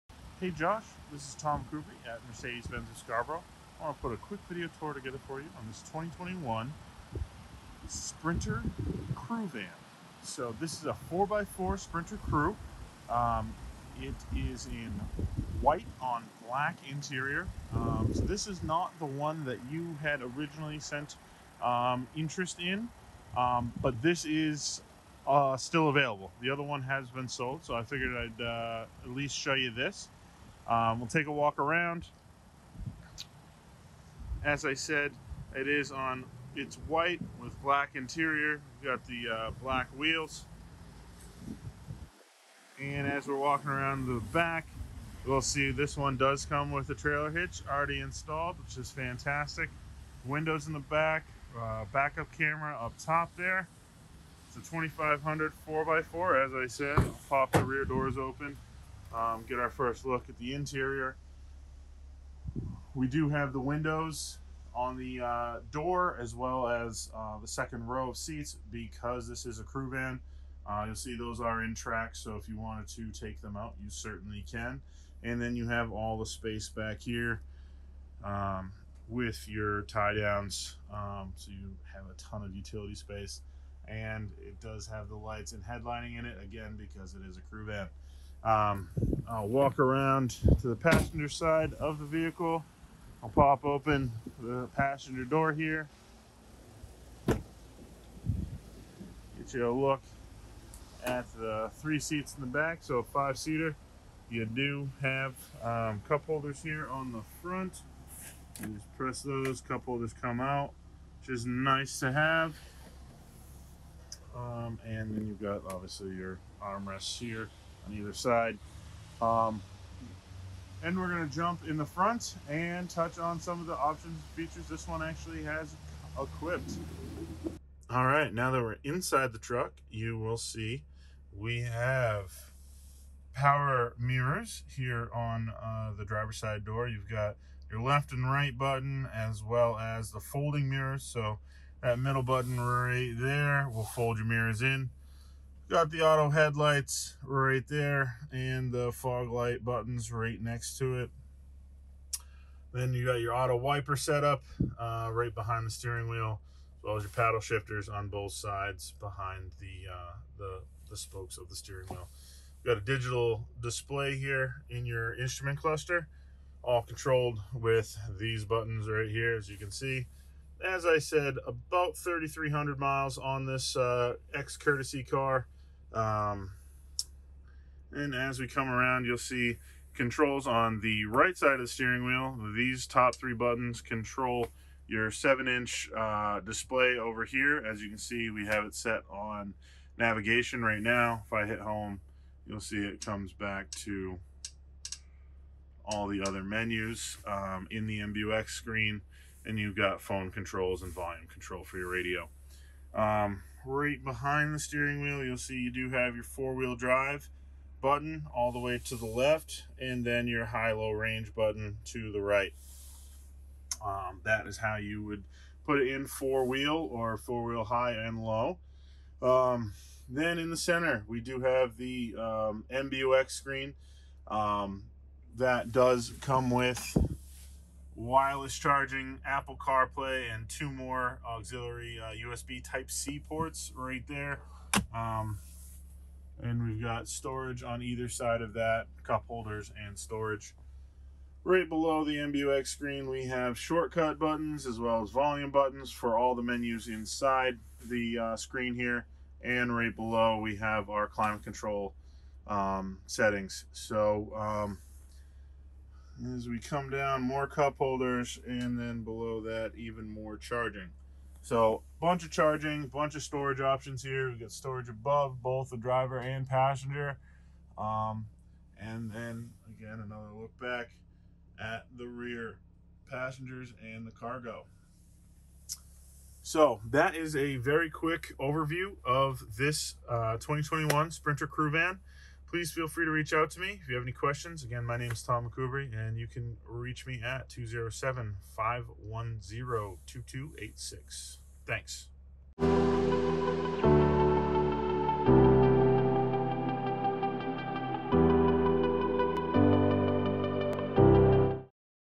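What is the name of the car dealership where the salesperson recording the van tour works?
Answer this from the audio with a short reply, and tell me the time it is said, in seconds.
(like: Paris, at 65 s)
Mercedes-Benz of Scarborough, at 2 s.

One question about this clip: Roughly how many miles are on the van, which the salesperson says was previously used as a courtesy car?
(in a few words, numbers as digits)
3,300.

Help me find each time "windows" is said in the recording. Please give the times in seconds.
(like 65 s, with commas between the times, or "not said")
50 s, 63 s.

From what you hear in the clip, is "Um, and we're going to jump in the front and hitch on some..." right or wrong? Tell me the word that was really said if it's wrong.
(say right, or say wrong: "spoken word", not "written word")
wrong: "touch", not "hitch".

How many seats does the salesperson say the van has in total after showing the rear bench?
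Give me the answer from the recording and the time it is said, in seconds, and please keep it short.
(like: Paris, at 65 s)
5, at 103 s.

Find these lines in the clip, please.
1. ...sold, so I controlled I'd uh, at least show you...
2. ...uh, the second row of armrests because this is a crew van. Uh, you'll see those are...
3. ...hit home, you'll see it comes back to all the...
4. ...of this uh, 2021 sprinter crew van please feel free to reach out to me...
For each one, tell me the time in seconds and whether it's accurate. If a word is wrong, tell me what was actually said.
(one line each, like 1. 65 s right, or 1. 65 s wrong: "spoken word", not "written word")
1. 27 s wrong: "figured", not "controlled"
2. 67 s wrong: "seats", not "armrests"
3. 191 s right
4. 279 s right.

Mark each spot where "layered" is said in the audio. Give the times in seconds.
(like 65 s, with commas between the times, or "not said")
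not said.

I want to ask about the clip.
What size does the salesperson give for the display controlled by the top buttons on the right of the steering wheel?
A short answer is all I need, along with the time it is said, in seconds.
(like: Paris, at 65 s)
7-inch, at 185 s.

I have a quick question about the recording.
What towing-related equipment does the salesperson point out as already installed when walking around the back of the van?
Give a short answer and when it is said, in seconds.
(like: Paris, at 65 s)
Trailer hitch, at 46 s.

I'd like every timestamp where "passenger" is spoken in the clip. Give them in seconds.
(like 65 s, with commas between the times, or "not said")
90 s, 94 s, 266 s, 273 s.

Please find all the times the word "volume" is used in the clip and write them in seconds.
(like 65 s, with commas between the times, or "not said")
200 s, 245 s.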